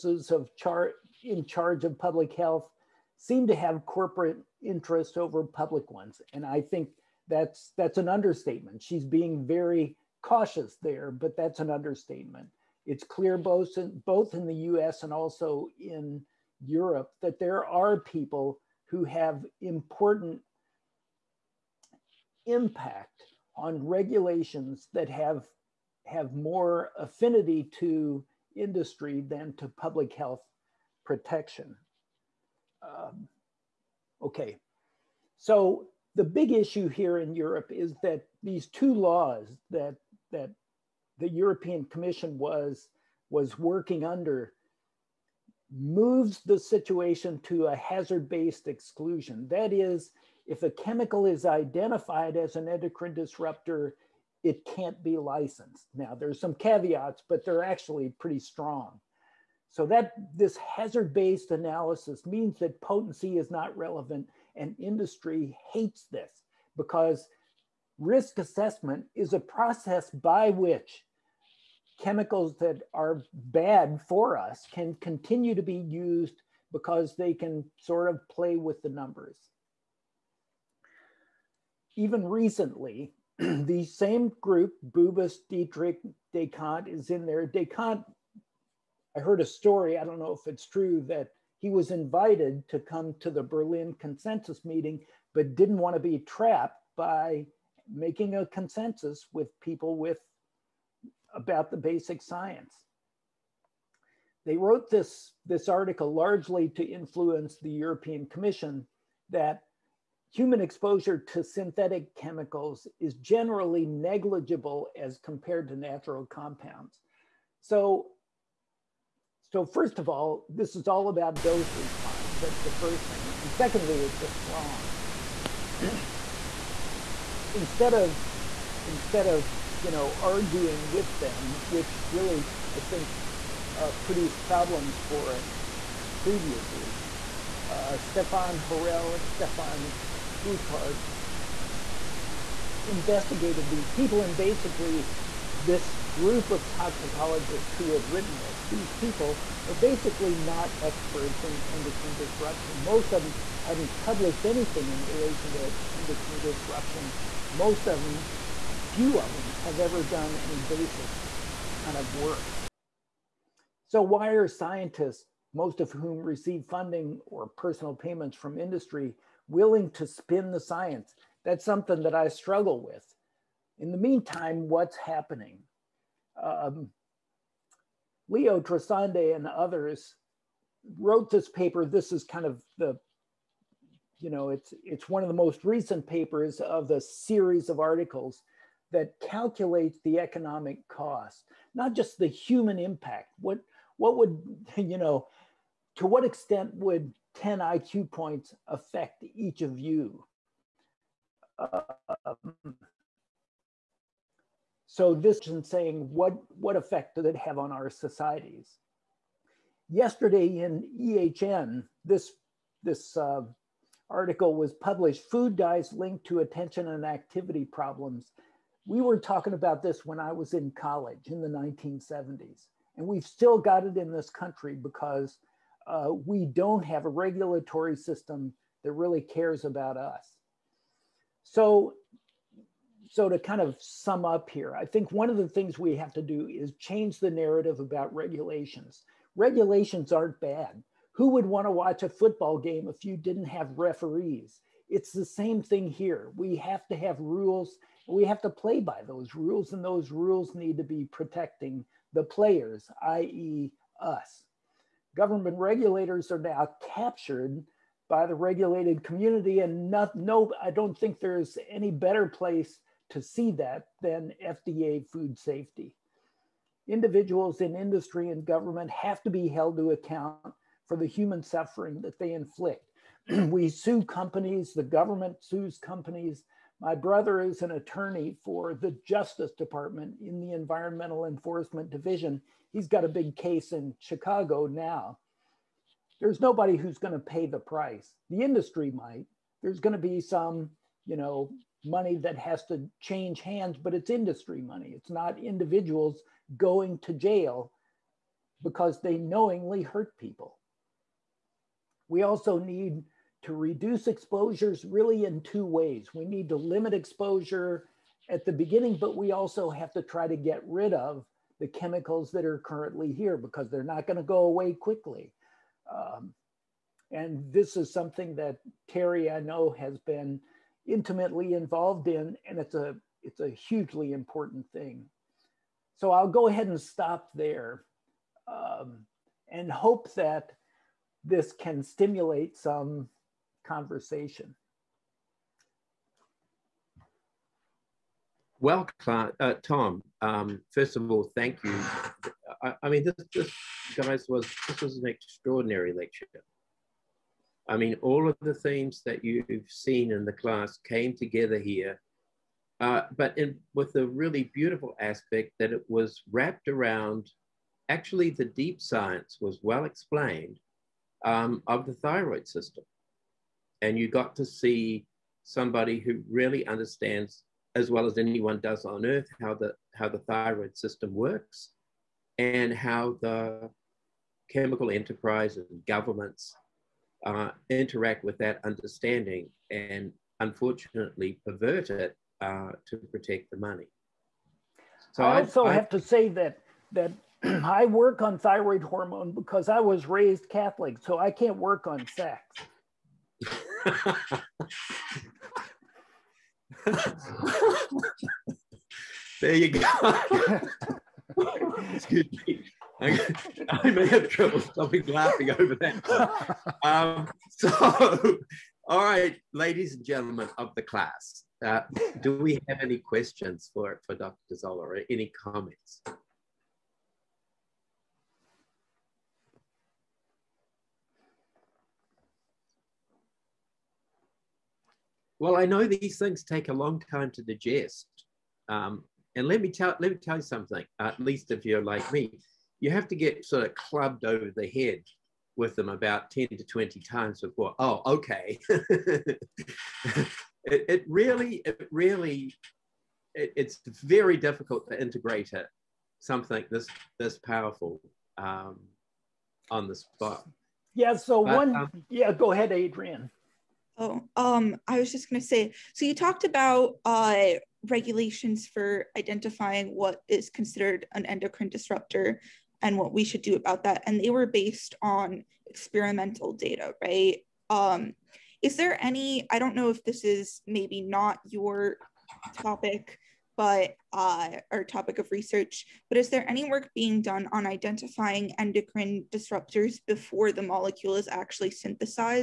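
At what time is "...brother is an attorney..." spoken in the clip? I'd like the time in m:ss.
4:36.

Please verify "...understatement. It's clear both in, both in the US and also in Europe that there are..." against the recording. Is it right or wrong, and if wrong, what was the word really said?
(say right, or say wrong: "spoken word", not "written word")
right.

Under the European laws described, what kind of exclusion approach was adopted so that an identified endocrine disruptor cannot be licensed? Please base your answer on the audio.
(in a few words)
hazard-based exclusion.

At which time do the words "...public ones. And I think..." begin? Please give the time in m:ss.
0:05.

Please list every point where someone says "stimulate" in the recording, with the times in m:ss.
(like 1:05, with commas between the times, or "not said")
5:31.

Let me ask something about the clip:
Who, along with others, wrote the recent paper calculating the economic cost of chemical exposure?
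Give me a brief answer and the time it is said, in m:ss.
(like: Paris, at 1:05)
Leo Trasande, at 2:58.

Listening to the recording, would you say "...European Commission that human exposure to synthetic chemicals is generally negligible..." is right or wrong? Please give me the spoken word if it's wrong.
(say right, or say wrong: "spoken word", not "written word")
right.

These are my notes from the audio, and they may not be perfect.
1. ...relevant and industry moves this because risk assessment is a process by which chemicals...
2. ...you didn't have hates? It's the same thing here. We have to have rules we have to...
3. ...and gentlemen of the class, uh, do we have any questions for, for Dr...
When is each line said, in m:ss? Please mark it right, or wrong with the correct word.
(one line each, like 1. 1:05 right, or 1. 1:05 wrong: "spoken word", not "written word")
1. 1:03 wrong: "hates", not "moves"
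2. 4:03 wrong: "referees", not "hates"
3. 6:49 right.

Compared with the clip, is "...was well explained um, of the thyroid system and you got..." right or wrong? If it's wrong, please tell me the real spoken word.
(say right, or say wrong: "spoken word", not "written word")
right.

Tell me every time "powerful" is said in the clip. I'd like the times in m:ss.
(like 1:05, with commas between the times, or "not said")
7:27.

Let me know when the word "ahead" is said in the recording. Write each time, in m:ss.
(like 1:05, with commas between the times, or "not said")
5:26, 7:32.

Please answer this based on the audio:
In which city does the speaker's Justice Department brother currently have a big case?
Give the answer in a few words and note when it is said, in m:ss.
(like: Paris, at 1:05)
Chicago, at 4:43.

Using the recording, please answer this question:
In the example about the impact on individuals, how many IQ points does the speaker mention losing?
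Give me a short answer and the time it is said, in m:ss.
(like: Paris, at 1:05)
10, at 3:17.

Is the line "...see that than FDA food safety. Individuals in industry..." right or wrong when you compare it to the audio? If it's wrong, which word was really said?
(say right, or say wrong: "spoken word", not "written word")
right.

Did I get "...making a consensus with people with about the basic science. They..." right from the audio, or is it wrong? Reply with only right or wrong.
right.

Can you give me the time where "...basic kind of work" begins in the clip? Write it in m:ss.
2:40.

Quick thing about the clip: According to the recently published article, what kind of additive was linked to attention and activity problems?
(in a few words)
Food dyes.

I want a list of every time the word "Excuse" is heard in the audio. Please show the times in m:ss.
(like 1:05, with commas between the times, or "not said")
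6:41.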